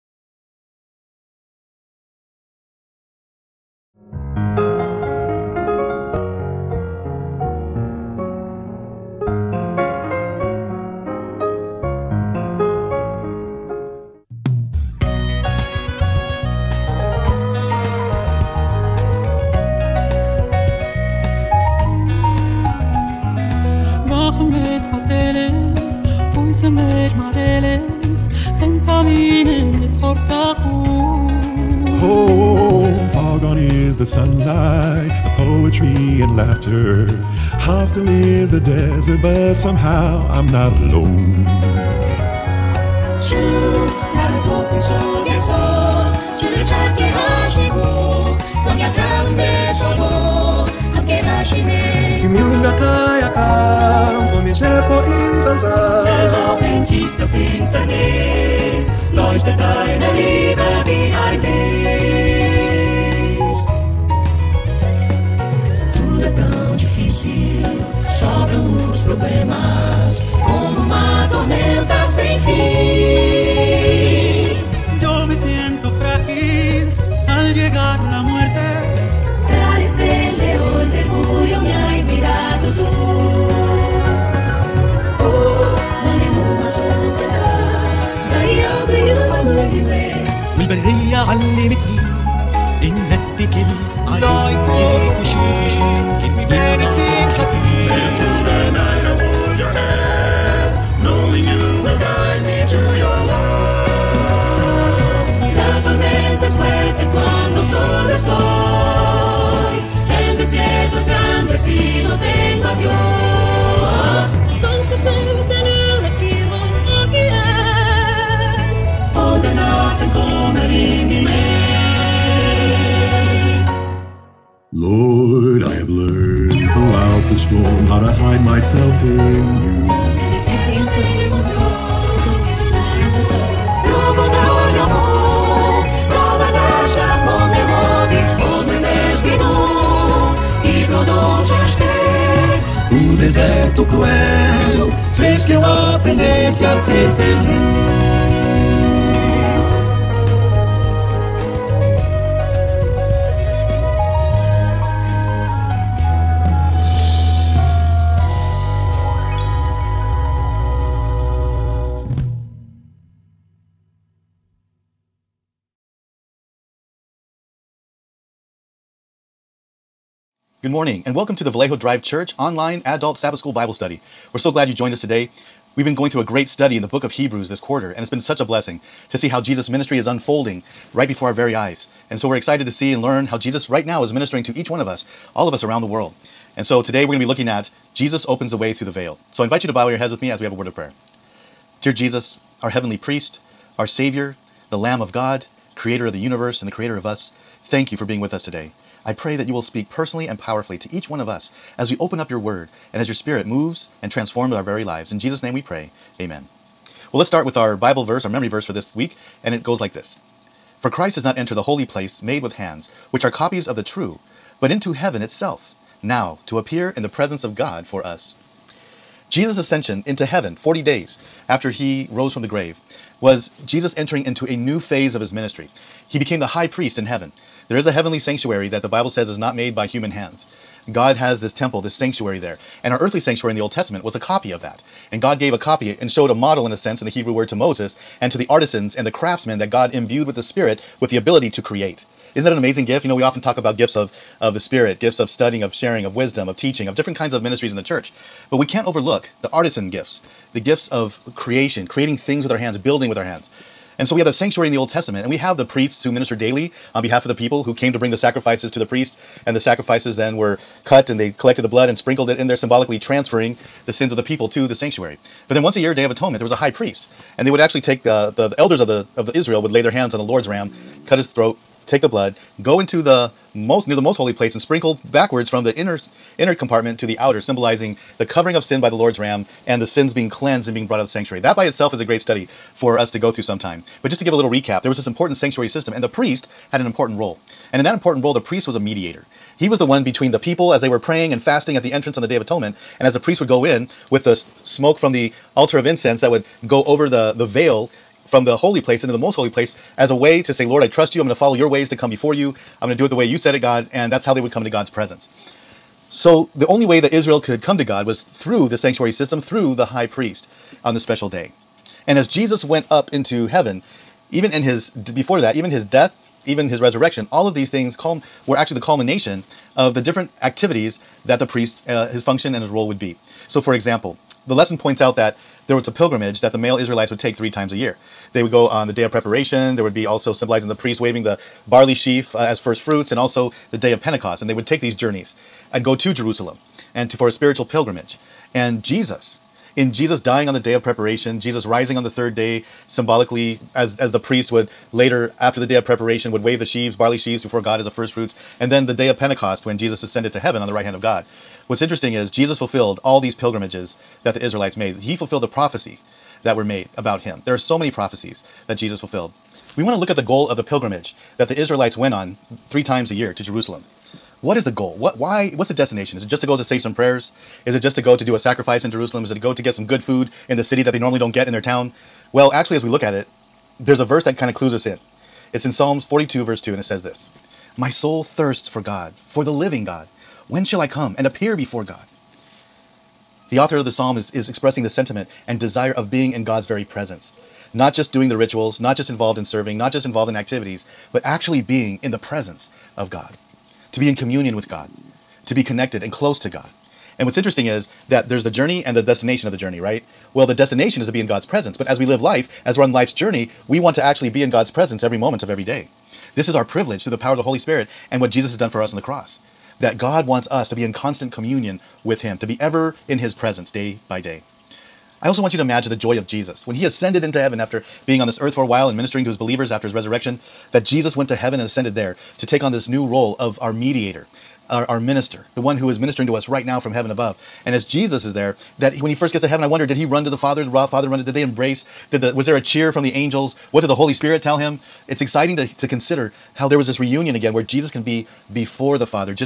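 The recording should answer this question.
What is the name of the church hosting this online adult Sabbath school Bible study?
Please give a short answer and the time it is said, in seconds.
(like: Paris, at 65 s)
Vallejo Drive Church, at 171 s.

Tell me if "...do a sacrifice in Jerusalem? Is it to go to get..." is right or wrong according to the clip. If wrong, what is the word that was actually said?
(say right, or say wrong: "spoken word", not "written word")
right.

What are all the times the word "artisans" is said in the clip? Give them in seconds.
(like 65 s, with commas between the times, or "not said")
238 s, 249 s.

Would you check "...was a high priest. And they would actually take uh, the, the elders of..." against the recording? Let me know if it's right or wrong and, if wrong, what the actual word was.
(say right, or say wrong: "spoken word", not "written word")
right.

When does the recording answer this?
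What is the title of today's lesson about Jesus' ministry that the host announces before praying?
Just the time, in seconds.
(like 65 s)
187 s.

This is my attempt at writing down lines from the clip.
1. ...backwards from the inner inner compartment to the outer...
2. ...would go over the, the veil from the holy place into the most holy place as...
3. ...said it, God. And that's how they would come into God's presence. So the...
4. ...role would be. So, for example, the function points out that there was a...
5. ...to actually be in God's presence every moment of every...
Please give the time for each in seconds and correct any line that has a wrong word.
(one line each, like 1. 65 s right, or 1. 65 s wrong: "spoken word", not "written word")
1. 275 s right
2. 296 s right
3. 303 s right
4. 322 s wrong: "lesson", not "function"
5. 403 s right.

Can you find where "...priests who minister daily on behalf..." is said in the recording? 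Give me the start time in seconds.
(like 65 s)
255 s.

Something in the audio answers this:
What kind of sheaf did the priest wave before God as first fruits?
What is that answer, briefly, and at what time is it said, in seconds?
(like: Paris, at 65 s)
Barley sheaf, at 331 s.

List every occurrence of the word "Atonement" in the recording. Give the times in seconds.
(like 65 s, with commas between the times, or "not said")
266 s, 292 s.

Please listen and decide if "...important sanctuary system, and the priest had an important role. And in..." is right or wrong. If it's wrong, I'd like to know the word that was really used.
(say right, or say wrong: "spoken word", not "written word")
right.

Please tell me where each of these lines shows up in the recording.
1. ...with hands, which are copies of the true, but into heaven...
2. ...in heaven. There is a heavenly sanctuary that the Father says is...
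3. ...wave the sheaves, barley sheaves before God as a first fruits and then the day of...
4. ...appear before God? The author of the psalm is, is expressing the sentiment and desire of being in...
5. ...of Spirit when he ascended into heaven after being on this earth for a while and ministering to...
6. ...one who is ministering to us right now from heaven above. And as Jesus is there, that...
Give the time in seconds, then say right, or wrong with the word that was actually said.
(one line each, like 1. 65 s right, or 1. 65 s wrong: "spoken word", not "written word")
1. 212 s right
2. 226 s wrong: "Bible", not "Father"
3. 346 s right
4. 381 s right
5. 416 s wrong: "Jesus", not "Spirit"
6. 425 s right.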